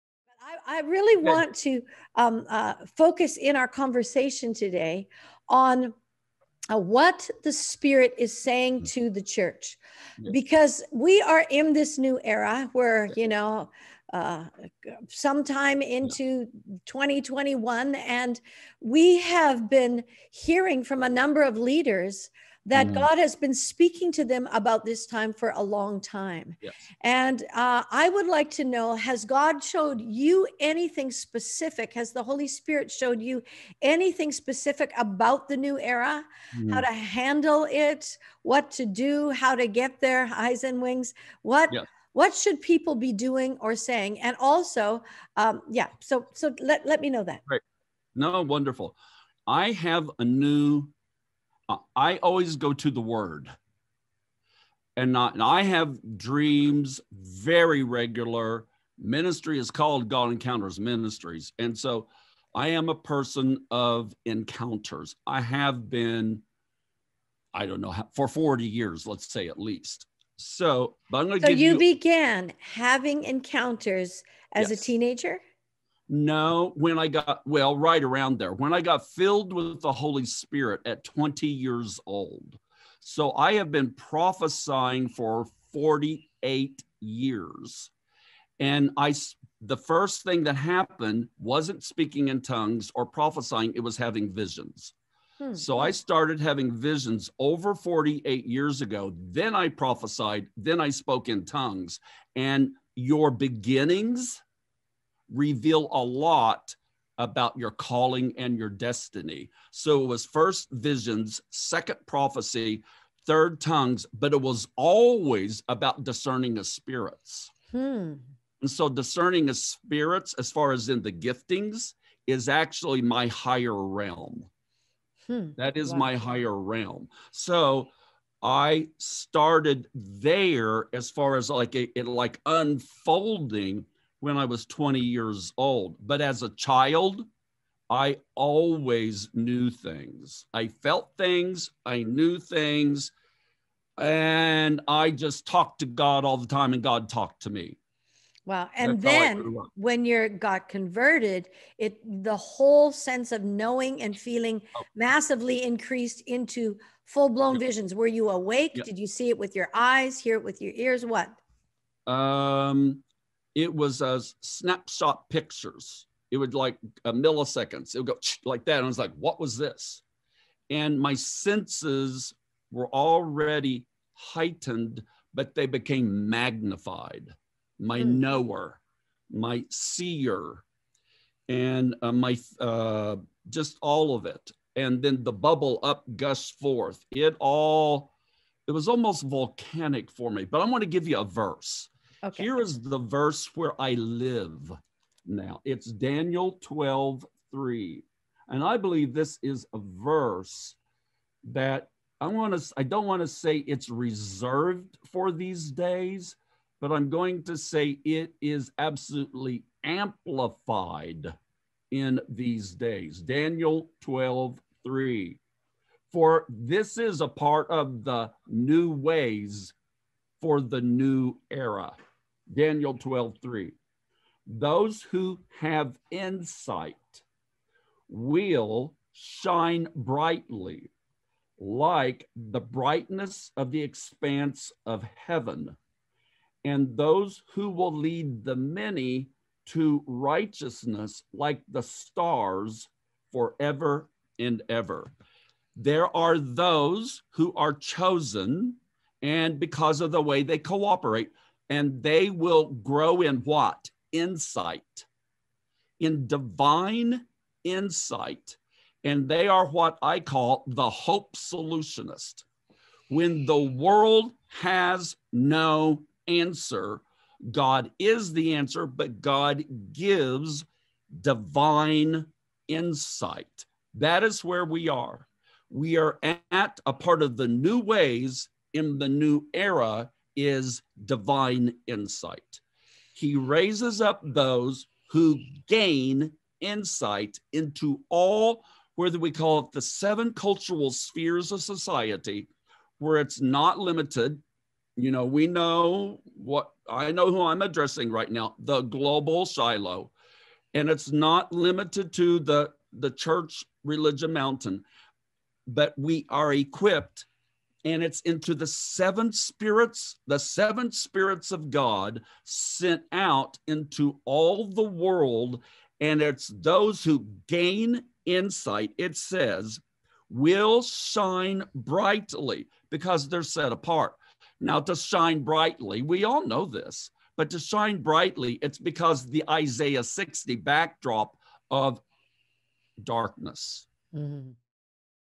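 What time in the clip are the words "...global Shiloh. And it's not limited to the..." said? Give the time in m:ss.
4:58.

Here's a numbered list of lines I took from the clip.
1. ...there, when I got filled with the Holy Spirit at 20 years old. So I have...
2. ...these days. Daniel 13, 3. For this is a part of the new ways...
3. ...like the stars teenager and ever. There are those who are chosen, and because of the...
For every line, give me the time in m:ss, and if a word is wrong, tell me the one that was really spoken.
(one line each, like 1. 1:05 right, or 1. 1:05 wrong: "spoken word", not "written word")
1. 1:18 right
2. 3:32 wrong: "12", not "13"
3. 4:01 wrong: "forever", not "teenager".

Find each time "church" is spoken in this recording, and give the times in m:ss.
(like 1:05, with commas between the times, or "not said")
0:09, 5:03.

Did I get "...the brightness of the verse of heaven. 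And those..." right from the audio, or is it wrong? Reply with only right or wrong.
wrong.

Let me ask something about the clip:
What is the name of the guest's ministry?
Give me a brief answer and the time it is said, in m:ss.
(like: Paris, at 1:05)
God Encounters Ministries, at 1:00.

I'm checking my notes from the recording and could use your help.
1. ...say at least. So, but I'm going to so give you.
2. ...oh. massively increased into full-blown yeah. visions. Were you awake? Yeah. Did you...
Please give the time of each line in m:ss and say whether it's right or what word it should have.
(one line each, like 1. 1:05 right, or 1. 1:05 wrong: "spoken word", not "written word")
1. 1:09 right
2. 2:34 right.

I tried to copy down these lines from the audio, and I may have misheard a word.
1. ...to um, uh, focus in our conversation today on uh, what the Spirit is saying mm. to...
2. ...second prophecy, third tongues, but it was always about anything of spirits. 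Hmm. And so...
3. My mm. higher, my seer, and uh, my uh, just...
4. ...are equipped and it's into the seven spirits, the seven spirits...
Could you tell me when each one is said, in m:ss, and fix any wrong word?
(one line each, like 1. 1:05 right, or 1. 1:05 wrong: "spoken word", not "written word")
1. 0:01 right
2. 1:51 wrong: "discerning", not "anything"
3. 2:57 wrong: "knower", not "higher"
4. 5:06 right.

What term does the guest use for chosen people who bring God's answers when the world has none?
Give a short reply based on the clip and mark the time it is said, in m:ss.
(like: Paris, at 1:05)
Hope solutionist, at 4:20.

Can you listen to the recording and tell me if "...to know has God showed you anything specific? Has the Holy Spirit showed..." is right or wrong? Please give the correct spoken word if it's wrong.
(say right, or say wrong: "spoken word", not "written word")
right.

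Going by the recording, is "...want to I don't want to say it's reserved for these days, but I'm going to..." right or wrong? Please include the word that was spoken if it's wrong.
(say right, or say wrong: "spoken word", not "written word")
right.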